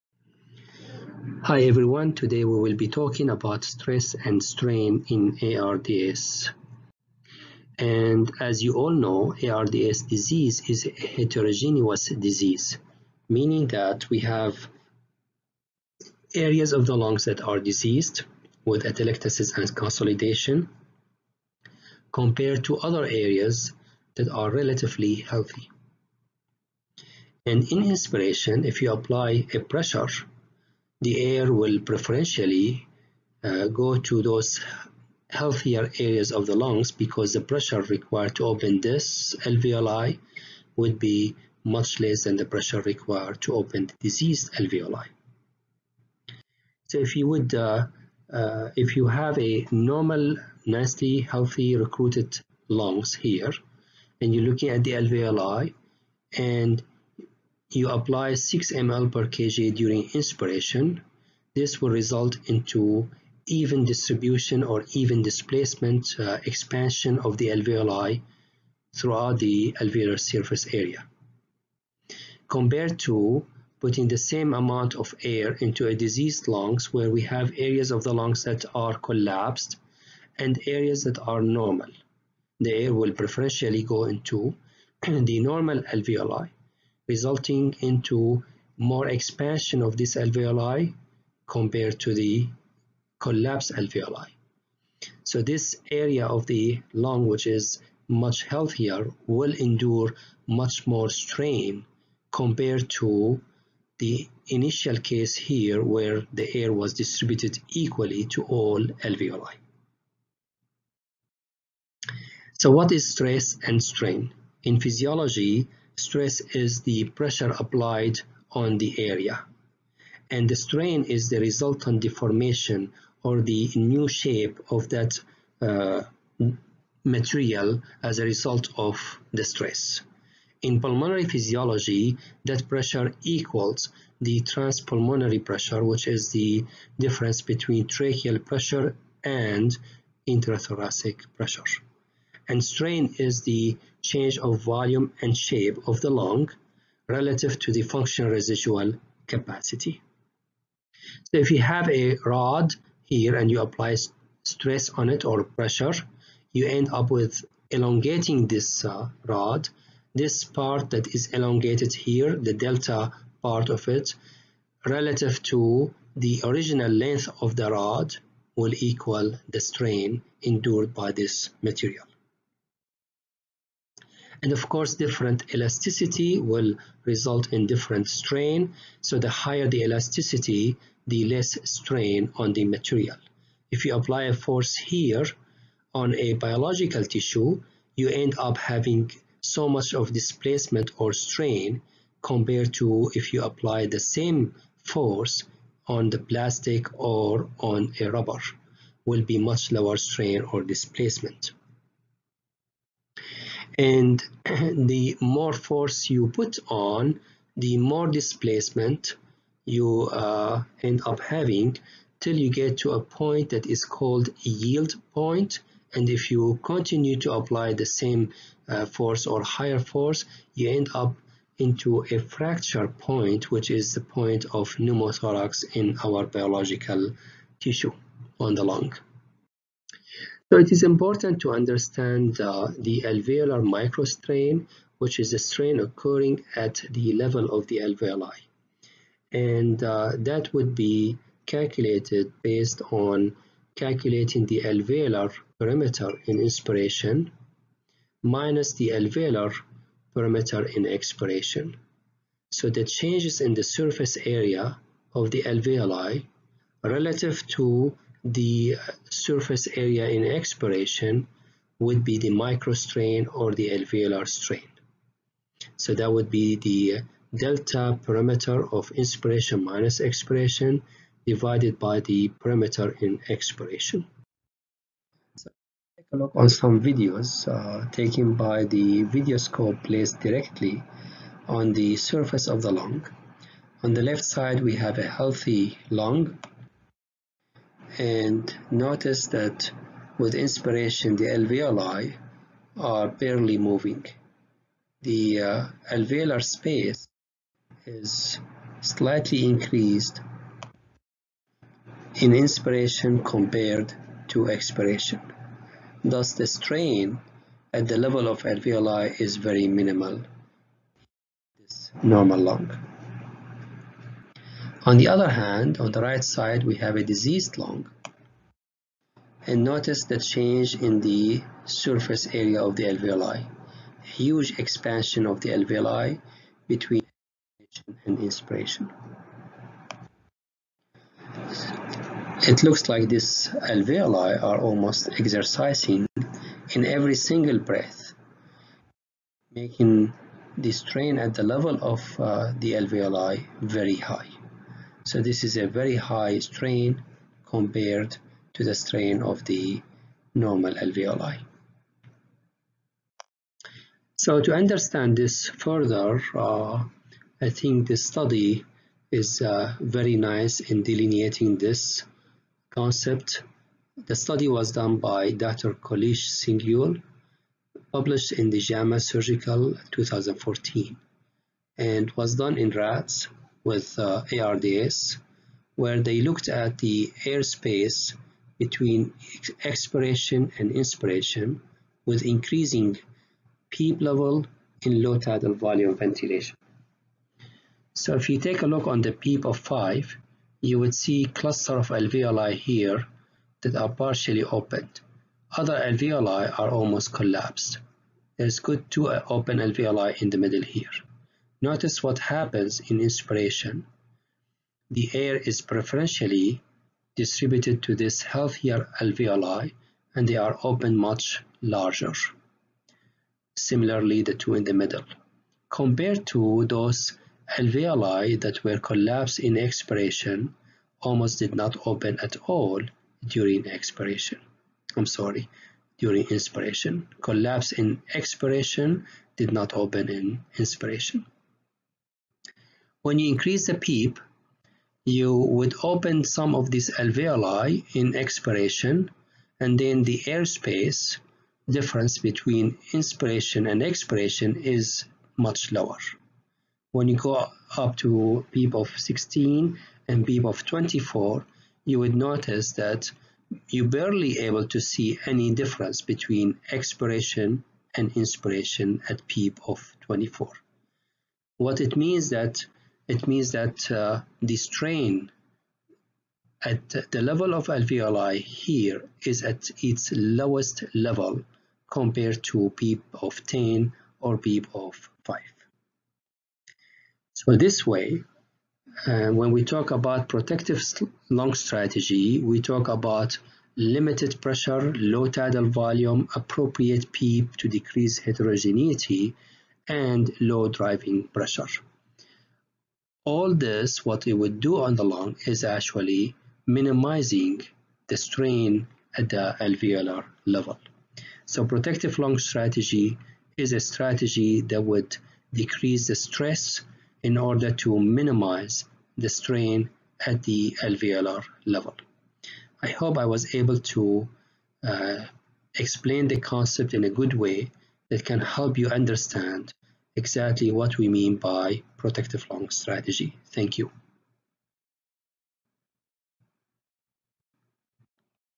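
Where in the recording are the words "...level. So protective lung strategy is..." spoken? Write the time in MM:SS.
08:20.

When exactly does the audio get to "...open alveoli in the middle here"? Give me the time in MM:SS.
06:39.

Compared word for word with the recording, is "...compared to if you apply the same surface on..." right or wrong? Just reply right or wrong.
wrong.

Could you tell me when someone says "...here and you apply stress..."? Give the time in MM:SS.
02:33.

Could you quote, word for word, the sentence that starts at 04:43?
On the left side we have a healthy lung and notice that with inspiration the alveoli are barely moving.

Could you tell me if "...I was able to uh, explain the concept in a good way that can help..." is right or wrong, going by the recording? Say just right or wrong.
right.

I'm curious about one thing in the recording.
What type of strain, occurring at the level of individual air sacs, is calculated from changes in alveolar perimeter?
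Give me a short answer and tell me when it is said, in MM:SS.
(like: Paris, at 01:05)
Alveolar microstrain, at 03:53.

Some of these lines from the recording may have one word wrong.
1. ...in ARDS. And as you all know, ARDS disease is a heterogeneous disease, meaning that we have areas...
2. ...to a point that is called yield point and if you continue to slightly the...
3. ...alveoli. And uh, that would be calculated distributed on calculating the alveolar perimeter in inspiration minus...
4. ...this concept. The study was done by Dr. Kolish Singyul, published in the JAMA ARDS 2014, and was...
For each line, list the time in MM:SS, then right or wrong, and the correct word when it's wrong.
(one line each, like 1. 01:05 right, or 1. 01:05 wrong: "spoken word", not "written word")
1. 00:05 right
2. 03:32 wrong: "apply", not "slightly"
3. 03:57 wrong: "based", not "distributed"
4. 06:01 wrong: "Surgical", not "ARDS".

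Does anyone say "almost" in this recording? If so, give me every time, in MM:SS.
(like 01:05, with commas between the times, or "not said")
05:34, 06:36, 07:00.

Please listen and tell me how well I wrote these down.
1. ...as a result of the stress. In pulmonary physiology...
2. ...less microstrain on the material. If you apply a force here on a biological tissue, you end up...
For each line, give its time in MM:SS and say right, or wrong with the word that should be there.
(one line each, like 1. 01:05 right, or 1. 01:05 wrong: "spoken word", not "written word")
1. 02:08 right
2. 03:01 wrong: "strain", not "microstrain".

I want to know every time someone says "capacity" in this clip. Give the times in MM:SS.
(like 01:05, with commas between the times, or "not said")
02:29.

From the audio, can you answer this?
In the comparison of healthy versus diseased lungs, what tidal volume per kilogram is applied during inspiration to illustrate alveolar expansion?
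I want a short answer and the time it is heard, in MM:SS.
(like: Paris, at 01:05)
6 ml per kg, at 00:58.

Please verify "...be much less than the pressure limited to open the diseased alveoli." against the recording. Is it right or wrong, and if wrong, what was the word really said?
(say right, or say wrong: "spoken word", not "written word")
wrong: "required", not "limited".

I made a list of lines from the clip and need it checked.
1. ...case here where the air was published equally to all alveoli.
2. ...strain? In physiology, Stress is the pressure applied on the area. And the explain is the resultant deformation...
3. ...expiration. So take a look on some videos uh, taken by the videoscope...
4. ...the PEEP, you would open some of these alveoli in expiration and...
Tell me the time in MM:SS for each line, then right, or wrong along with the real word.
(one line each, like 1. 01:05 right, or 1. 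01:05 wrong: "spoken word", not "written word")
1. 01:45 wrong: "distributed", not "published"
2. 01:53 wrong: "strain", not "explain"
3. 04:33 right
4. 07:13 right.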